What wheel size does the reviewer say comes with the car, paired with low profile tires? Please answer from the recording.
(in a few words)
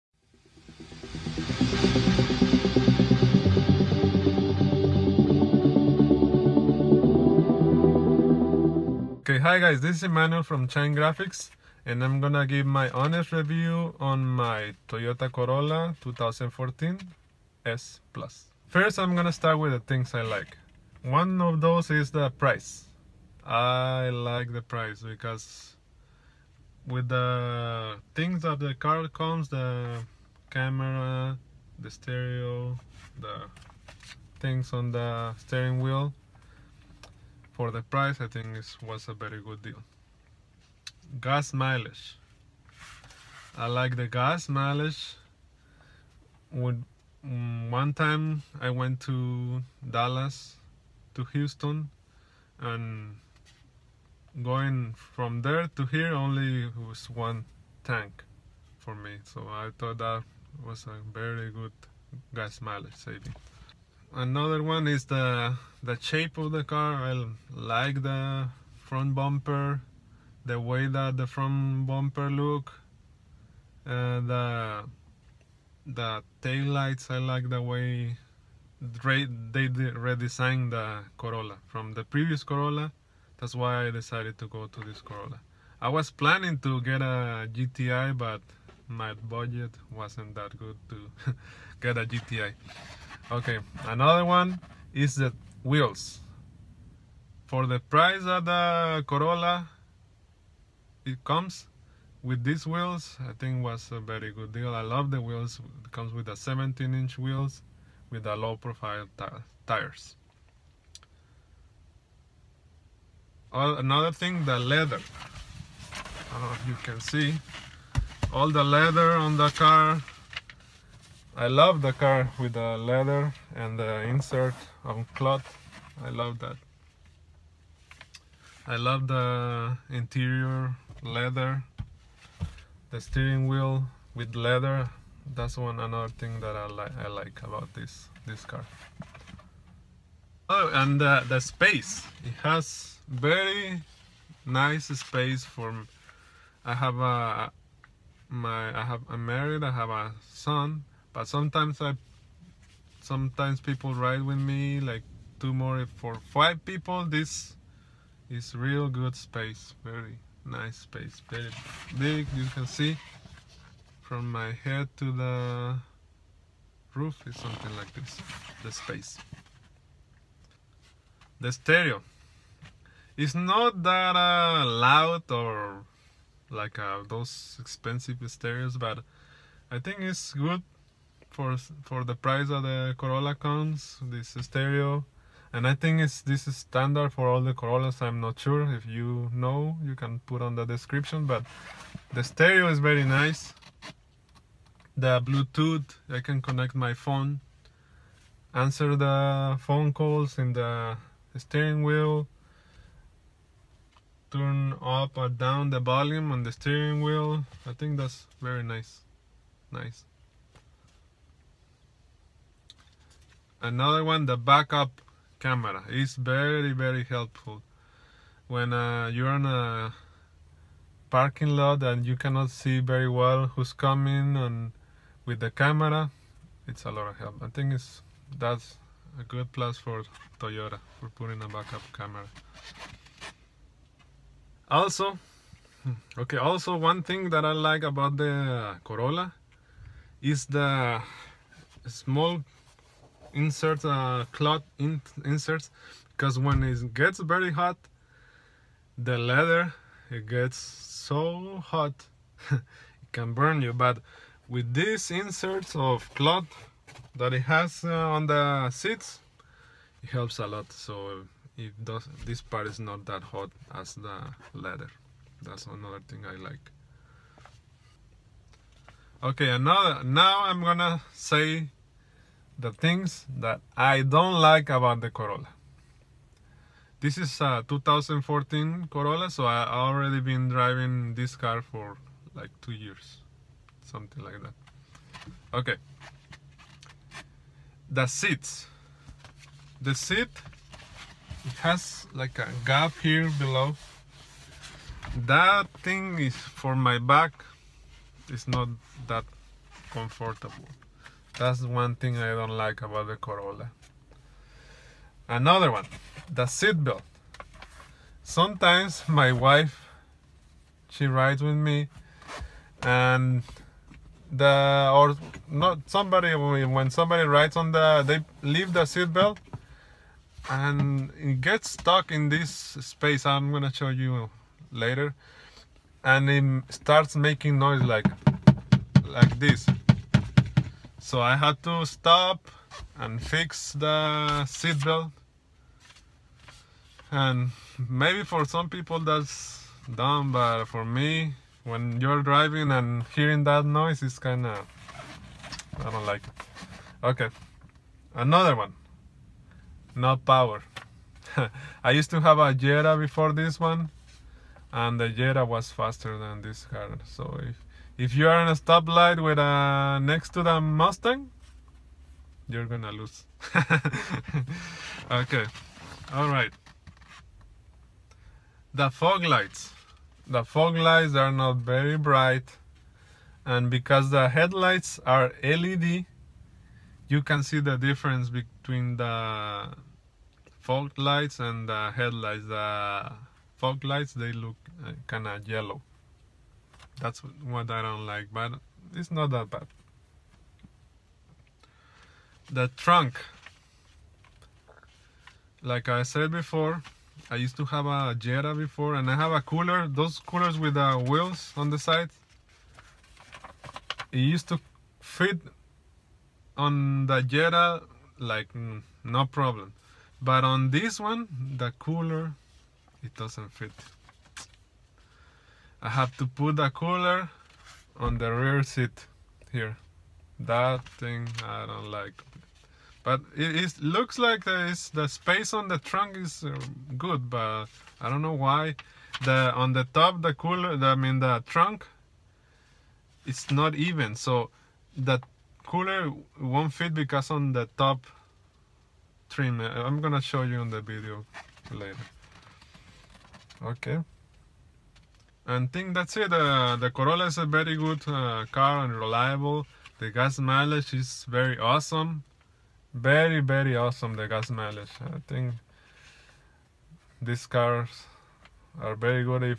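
17 inch.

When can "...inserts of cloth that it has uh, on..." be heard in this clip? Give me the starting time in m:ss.
4:15.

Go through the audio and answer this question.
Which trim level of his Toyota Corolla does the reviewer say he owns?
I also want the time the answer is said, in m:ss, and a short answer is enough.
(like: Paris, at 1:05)
S Plus, at 0:17.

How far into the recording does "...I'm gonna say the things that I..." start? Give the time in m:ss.
4:30.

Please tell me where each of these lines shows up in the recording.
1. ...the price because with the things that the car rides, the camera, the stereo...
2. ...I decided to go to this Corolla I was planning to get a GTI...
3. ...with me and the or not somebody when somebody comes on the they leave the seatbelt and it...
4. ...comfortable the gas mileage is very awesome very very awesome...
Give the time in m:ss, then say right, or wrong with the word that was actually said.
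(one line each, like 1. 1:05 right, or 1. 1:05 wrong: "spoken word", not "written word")
1. 0:24 wrong: "comes", not "rides"
2. 1:23 right
3. 5:11 wrong: "rides", not "comes"
4. 7:28 wrong: "reliable", not "comfortable".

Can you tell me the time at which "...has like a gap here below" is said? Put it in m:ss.
4:51.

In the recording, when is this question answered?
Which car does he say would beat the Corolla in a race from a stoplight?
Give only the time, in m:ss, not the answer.
6:00.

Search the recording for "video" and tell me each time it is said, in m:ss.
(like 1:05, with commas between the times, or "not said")
7:20.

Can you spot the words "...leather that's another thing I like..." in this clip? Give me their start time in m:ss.
4:24.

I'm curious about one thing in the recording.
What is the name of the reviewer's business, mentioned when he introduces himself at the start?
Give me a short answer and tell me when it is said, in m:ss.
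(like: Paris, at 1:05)
Shine Graffix, at 0:10.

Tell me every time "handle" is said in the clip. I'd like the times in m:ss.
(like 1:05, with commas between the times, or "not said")
not said.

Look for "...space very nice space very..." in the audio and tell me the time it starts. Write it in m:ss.
2:39.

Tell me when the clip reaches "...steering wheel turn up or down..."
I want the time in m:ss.
3:21.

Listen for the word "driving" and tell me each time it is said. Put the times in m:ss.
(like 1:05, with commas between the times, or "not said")
4:40, 5:42.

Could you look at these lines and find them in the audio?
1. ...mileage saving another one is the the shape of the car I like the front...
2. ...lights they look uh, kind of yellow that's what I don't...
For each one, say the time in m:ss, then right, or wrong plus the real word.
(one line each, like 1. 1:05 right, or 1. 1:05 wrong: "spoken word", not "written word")
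1. 1:02 right
2. 6:23 right.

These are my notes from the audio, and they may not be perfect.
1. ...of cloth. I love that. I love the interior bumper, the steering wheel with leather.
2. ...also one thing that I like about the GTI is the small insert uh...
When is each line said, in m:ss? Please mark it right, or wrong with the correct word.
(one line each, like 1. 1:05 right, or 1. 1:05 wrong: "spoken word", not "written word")
1. 2:04 wrong: "leather", not "bumper"
2. 3:56 wrong: "Corolla", not "GTI".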